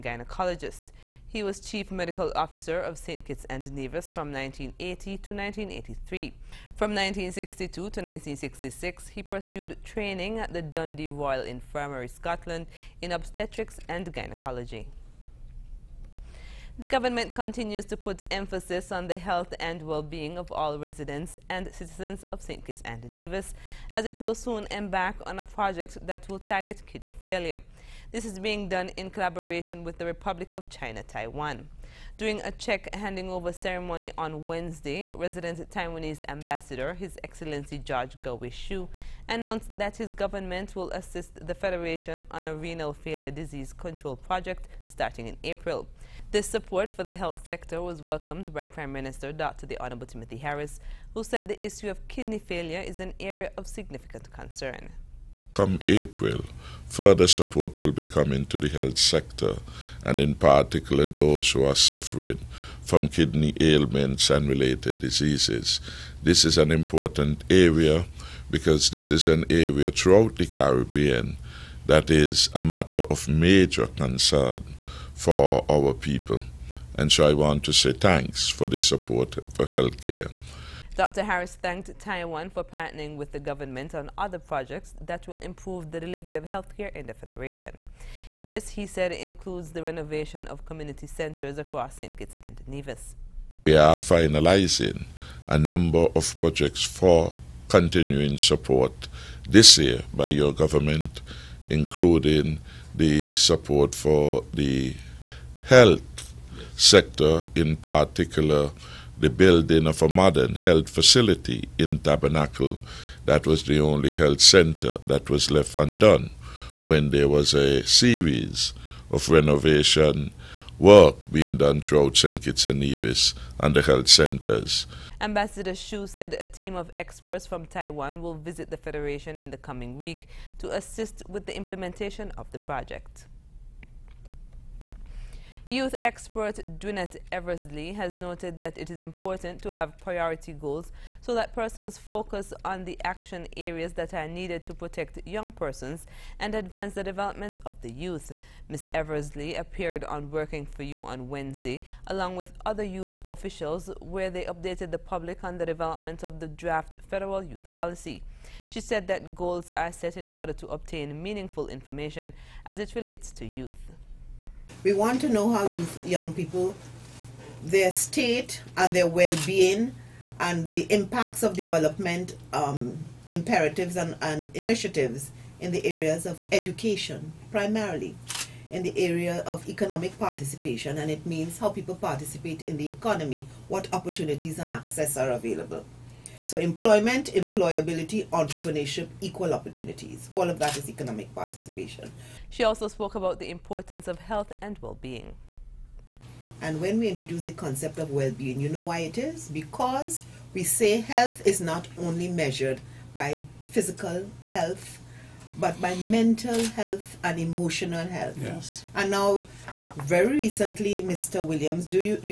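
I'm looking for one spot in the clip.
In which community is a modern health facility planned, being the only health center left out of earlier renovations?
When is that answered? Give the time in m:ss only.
1:51.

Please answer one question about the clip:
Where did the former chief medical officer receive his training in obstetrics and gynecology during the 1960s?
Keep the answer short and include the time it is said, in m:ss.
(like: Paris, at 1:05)
Dundee Royal Infirmary, at 0:10.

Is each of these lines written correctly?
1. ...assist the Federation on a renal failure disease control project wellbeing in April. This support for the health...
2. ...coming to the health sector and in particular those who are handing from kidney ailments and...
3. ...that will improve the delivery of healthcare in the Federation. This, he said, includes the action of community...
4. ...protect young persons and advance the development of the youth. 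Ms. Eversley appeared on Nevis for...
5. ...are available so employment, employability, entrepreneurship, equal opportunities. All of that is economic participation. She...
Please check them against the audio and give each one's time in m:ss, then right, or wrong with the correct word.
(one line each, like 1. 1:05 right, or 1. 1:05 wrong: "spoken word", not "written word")
1. 0:40 wrong: "starting", not "wellbeing"
2. 0:58 wrong: "suffering", not "handing"
3. 1:25 wrong: "renovation", not "action"
4. 2:24 wrong: "Working", not "Nevis"
5. 3:05 right.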